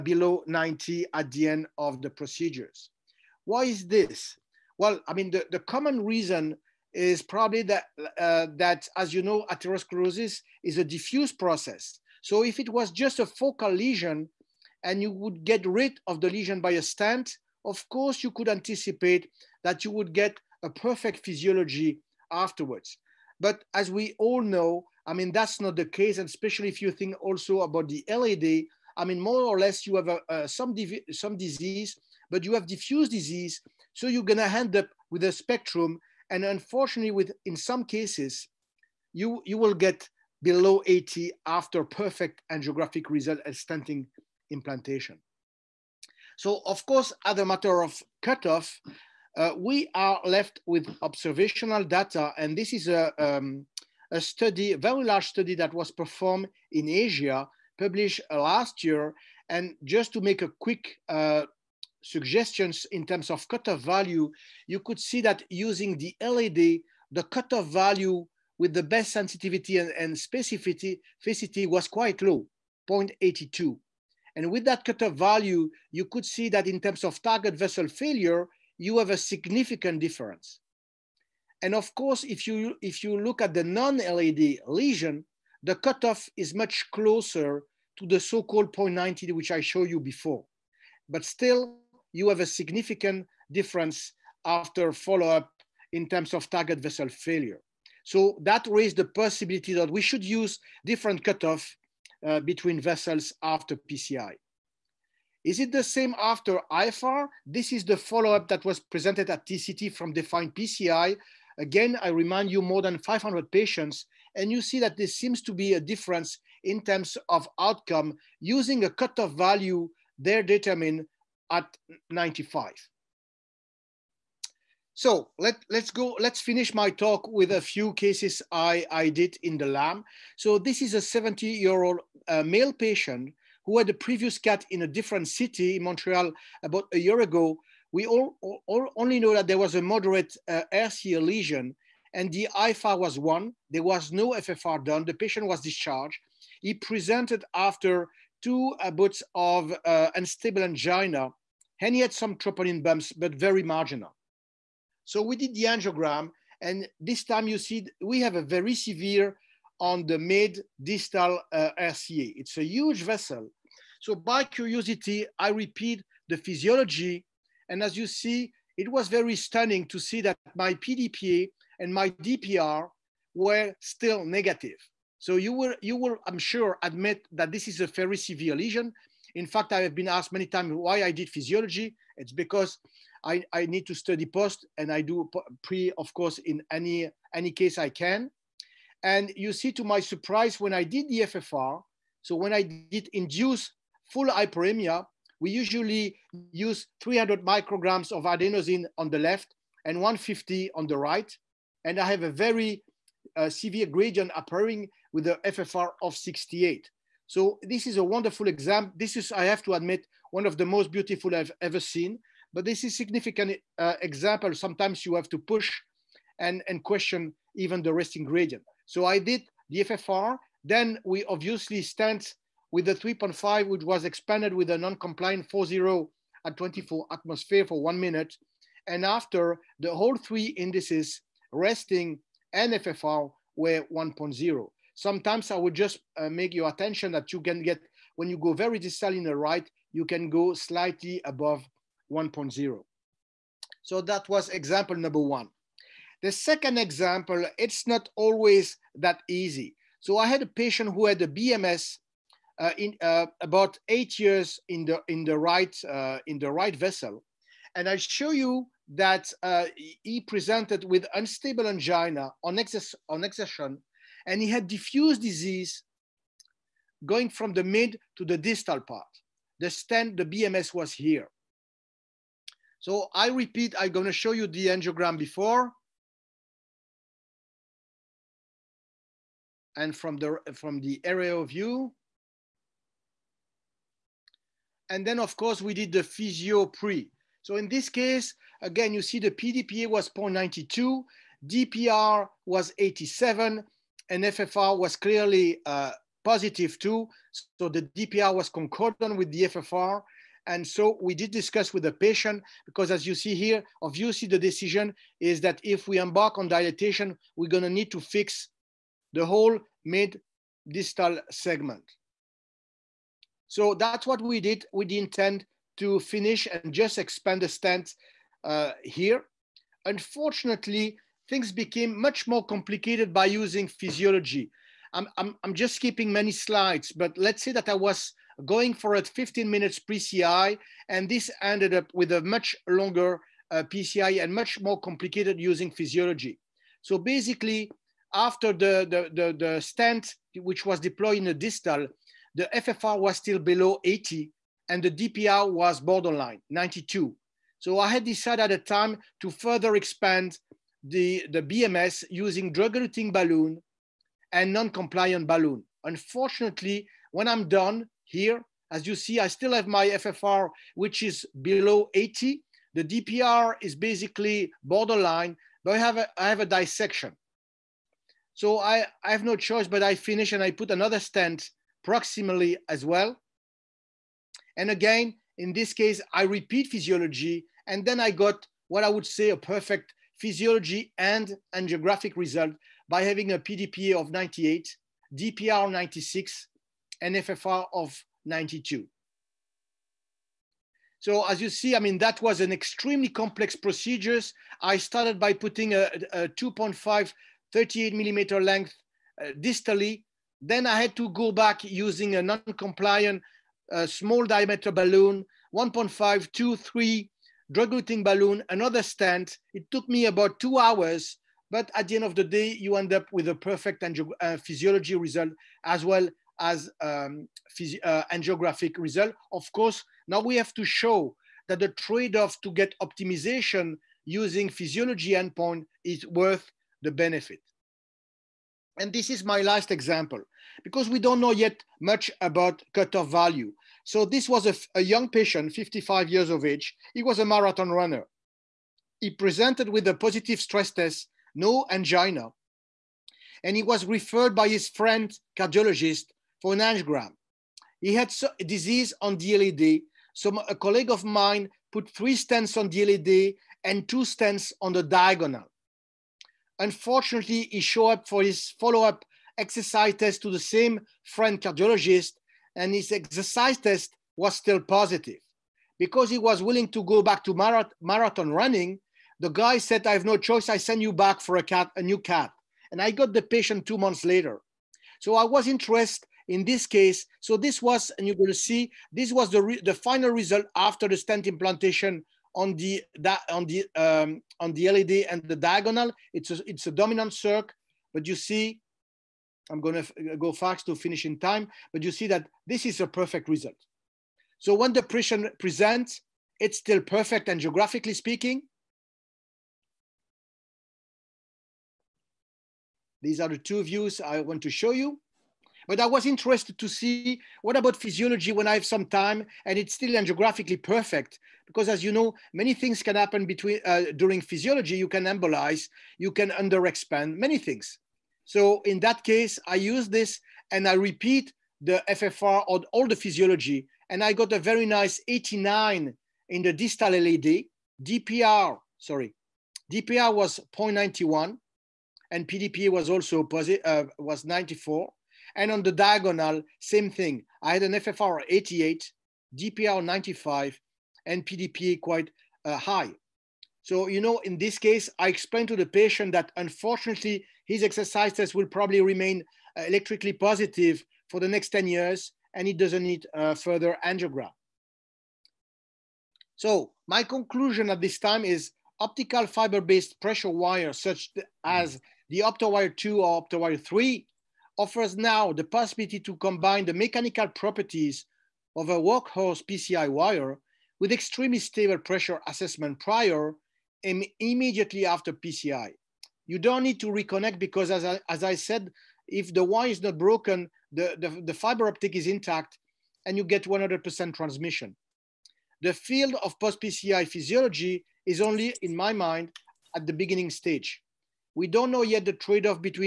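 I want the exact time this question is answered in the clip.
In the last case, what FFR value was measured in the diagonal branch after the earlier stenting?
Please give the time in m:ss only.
8:57.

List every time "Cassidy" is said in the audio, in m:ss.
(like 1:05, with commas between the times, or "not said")
not said.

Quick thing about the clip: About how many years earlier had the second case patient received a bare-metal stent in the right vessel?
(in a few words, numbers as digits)
8.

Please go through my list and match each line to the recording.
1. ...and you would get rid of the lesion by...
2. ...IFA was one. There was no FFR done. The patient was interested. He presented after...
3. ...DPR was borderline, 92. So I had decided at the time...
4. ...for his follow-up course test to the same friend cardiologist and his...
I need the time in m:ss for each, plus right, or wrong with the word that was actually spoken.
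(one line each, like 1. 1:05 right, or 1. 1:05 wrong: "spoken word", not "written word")
1. 0:14 right
2. 2:22 wrong: "discharged", not "interested"
3. 5:44 right
4. 7:38 wrong: "exercise", not "course".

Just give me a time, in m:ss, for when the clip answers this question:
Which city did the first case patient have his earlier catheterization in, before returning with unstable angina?
2:15.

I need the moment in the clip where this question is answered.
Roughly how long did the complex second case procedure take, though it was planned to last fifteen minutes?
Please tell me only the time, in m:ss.
6:50.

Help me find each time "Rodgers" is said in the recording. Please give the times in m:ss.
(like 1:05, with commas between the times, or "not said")
not said.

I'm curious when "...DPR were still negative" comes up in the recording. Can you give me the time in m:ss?
2:52.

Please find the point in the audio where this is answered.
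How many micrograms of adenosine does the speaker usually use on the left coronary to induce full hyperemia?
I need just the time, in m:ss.
3:17.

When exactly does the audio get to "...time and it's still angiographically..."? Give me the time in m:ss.
8:28.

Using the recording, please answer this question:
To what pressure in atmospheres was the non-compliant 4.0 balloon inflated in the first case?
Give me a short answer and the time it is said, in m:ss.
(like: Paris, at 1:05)
24, at 3:46.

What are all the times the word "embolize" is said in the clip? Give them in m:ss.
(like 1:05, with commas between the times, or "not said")
8:35.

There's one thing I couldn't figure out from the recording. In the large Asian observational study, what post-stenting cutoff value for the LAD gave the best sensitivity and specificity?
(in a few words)
0.82.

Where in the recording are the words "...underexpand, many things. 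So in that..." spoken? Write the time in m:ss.
8:36.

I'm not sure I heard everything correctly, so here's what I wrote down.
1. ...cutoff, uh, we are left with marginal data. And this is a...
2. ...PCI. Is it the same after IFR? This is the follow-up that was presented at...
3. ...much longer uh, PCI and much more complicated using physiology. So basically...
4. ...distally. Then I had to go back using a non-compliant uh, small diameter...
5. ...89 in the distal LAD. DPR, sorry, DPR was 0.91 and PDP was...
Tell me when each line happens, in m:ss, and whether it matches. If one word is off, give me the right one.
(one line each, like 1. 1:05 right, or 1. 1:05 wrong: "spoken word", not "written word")
1. 0:48 wrong: "observational", not "marginal"
2. 1:43 right
3. 5:32 right
4. 6:39 right
5. 8:45 right.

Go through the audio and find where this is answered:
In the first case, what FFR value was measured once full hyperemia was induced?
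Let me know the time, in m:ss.
3:26.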